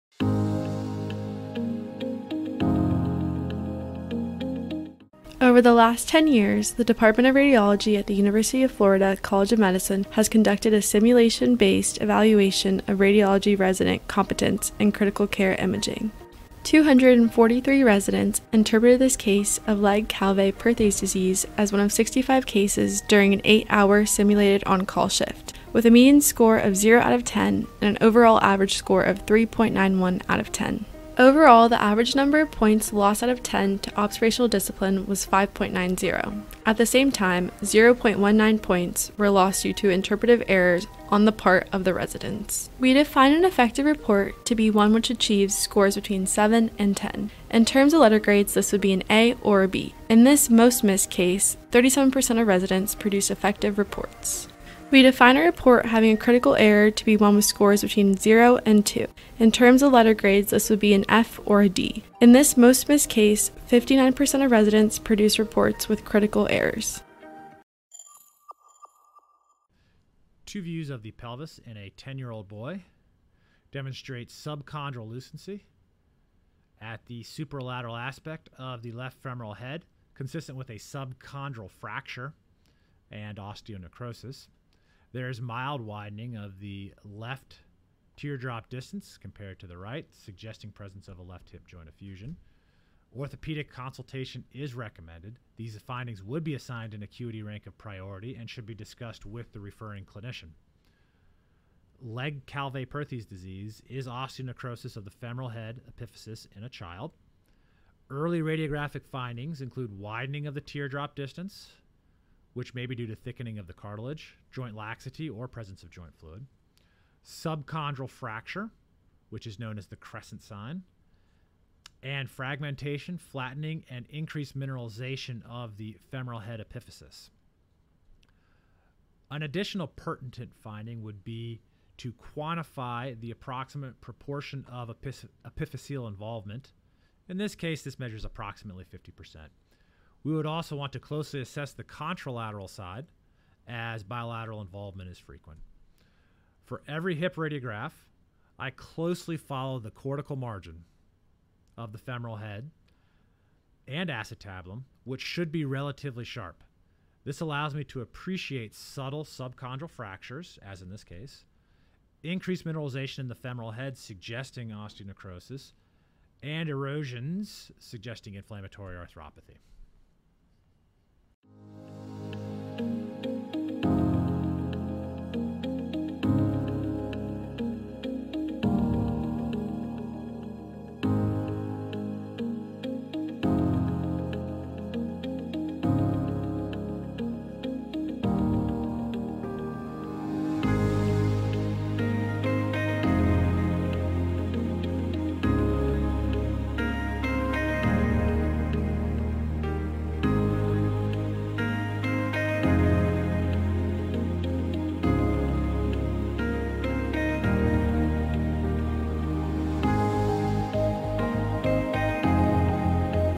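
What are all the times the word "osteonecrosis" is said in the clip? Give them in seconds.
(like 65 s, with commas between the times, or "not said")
83 s, 104 s, 164 s.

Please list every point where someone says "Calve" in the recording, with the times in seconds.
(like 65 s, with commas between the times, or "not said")
20 s, 102 s.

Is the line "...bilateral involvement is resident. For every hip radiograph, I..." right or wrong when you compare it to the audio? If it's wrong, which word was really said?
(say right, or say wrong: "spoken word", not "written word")
wrong: "frequent", not "resident".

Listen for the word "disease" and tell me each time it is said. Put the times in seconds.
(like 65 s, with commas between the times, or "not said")
20 s, 103 s.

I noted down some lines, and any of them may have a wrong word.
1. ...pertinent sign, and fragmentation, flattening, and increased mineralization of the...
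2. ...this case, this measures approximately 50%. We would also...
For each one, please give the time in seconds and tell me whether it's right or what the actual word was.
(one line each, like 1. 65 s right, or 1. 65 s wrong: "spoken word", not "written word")
1. 119 s wrong: "crescent", not "pertinent"
2. 137 s right.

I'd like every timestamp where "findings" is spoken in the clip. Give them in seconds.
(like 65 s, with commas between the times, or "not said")
95 s, 109 s, 130 s.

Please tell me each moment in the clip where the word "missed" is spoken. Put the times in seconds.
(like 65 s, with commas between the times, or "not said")
50 s, 62 s.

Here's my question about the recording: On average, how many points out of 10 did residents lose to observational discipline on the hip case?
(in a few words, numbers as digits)
5.90.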